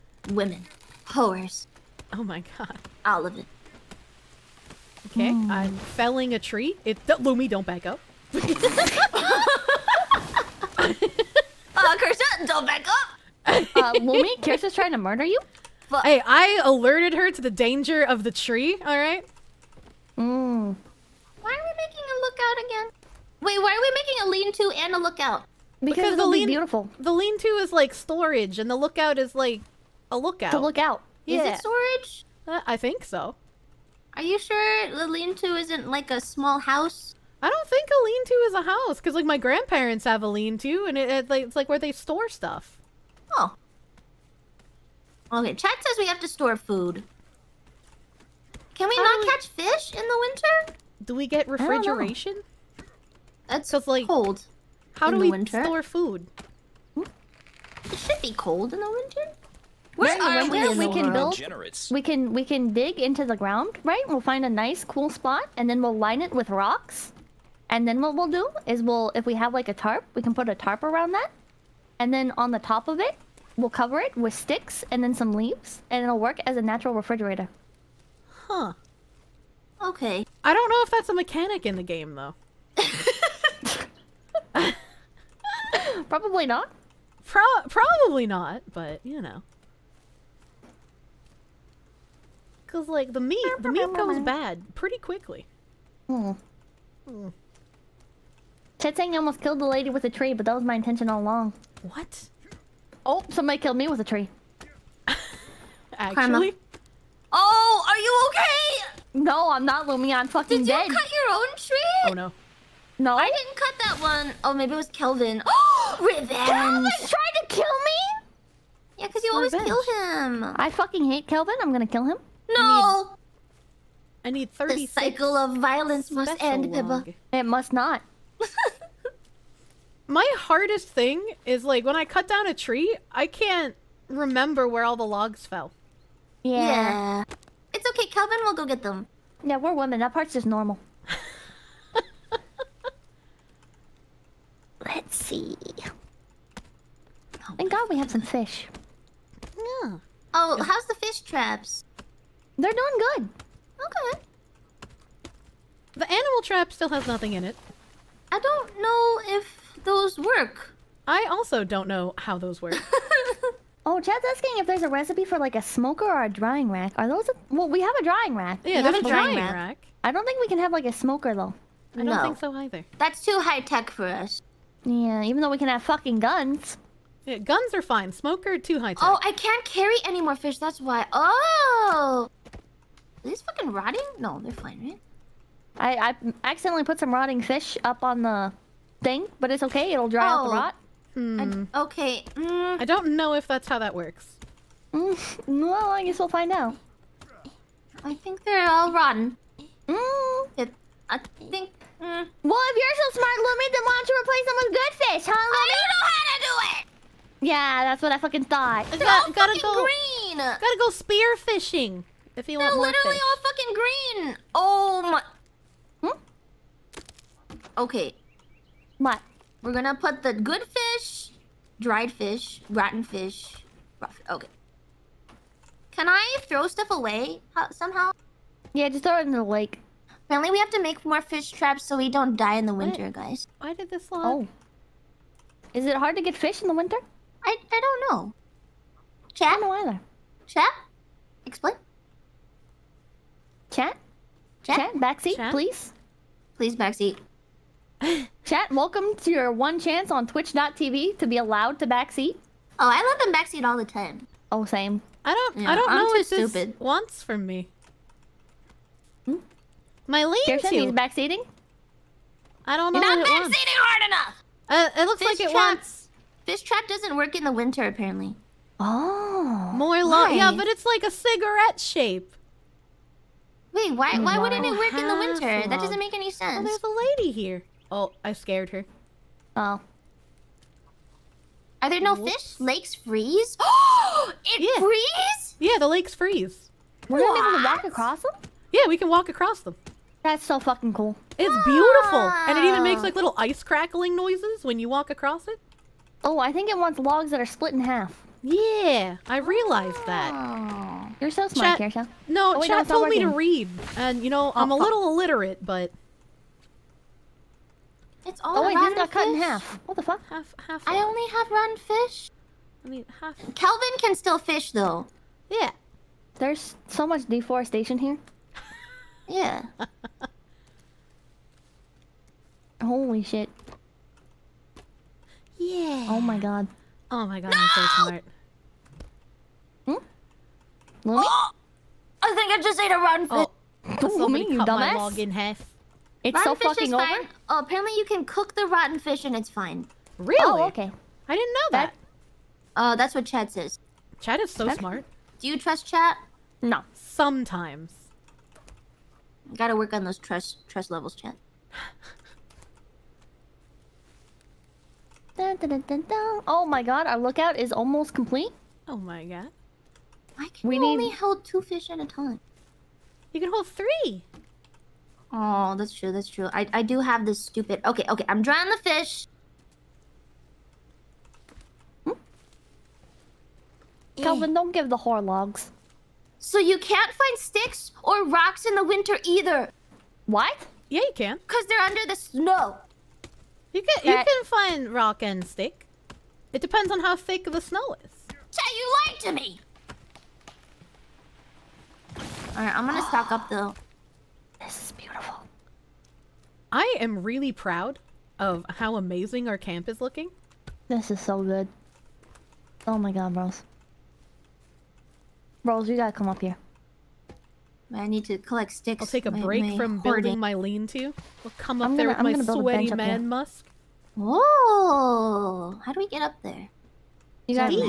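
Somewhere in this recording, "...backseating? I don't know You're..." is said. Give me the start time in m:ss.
4:20.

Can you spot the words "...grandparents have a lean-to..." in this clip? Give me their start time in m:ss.
0:39.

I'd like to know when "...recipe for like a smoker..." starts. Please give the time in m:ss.
2:44.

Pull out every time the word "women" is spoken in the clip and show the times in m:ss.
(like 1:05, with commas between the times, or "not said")
0:00, 2:19.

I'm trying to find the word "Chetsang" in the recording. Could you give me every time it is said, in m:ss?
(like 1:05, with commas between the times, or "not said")
1:38.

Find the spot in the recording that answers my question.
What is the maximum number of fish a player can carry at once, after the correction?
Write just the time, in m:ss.
6:03.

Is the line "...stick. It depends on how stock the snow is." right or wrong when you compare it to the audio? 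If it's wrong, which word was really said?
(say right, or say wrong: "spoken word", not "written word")
wrong: "thick", not "stock".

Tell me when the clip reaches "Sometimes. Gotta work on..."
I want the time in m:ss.
5:46.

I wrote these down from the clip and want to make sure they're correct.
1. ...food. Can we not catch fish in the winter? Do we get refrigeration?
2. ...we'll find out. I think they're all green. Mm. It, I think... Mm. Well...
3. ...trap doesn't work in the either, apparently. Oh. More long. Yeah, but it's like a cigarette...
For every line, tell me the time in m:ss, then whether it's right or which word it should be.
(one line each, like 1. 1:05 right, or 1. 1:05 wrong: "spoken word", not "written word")
1. 0:46 right
2. 3:16 wrong: "rotten", not "green"
3. 4:26 wrong: "winter", not "either".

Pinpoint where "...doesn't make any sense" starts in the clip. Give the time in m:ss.
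4:35.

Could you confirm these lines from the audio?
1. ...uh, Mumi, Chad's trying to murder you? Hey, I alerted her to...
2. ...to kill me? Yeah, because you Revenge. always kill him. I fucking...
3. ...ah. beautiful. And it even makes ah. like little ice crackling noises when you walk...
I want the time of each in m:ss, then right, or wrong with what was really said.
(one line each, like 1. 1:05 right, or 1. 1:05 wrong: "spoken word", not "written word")
1. 0:13 wrong: "Kirsche", not "Chad"
2. 1:57 right
3. 4:51 right.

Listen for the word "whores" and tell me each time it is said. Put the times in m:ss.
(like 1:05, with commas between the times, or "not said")
0:01, 6:14.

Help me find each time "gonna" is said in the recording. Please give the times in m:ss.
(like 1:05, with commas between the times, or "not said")
2:01, 3:39, 4:47, 6:32, 6:51.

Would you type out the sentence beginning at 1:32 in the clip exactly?
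Because, like, the meat, the meat goes bad pretty quickly.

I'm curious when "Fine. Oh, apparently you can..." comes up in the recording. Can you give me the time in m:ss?
5:37.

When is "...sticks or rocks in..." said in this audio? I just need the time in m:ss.
6:17.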